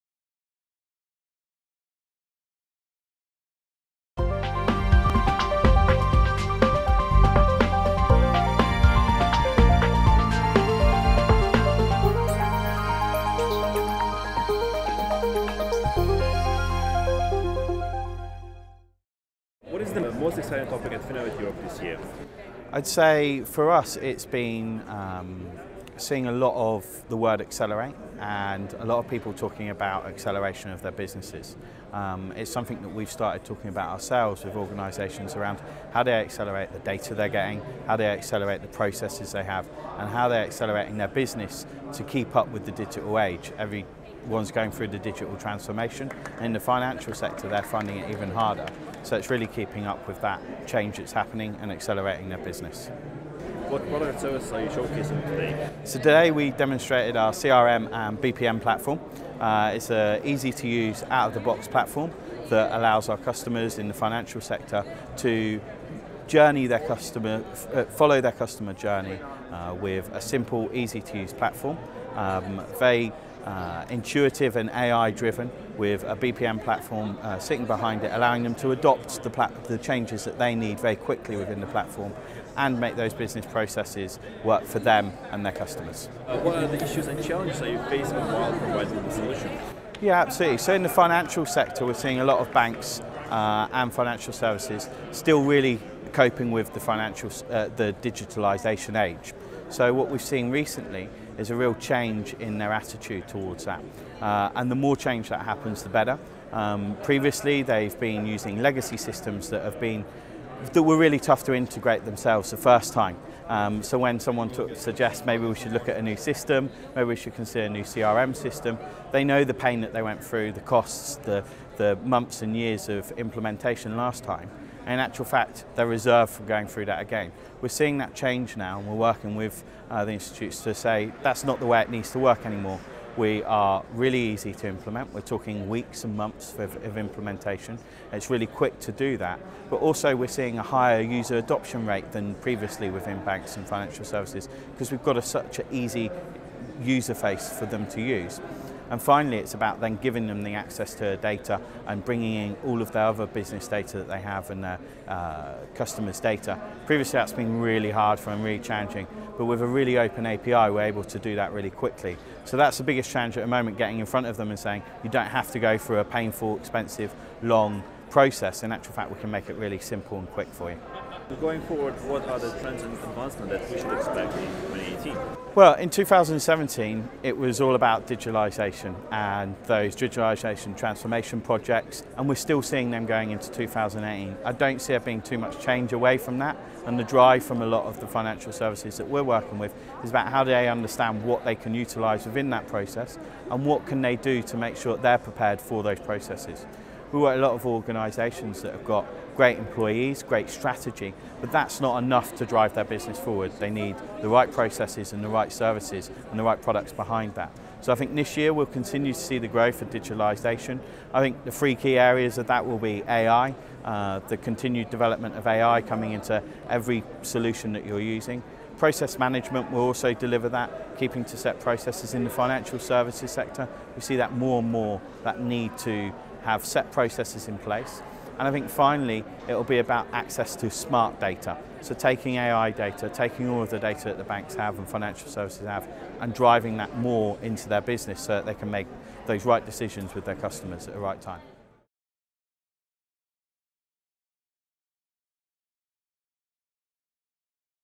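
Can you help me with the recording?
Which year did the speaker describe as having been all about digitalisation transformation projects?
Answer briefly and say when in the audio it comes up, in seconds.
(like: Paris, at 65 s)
2017, at 175 s.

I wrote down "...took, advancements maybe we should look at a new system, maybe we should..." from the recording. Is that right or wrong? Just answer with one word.
wrong.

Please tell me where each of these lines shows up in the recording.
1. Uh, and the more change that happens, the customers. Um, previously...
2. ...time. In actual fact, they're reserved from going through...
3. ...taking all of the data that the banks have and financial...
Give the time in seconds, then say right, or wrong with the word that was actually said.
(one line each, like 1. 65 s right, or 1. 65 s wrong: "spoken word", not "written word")
1. 104 s wrong: "better", not "customers"
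2. 124 s right
3. 233 s right.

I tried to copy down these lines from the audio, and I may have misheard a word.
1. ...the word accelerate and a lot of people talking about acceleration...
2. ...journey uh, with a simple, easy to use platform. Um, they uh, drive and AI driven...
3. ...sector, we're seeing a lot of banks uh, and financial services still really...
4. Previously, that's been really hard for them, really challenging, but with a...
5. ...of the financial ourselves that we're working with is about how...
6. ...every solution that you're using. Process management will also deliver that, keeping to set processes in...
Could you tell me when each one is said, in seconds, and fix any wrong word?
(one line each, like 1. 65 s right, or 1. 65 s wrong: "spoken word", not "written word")
1. 27 s right
2. 68 s wrong: "intuitive", not "drive"
3. 91 s right
4. 156 s right
5. 187 s wrong: "services", not "ourselves"
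6. 216 s right.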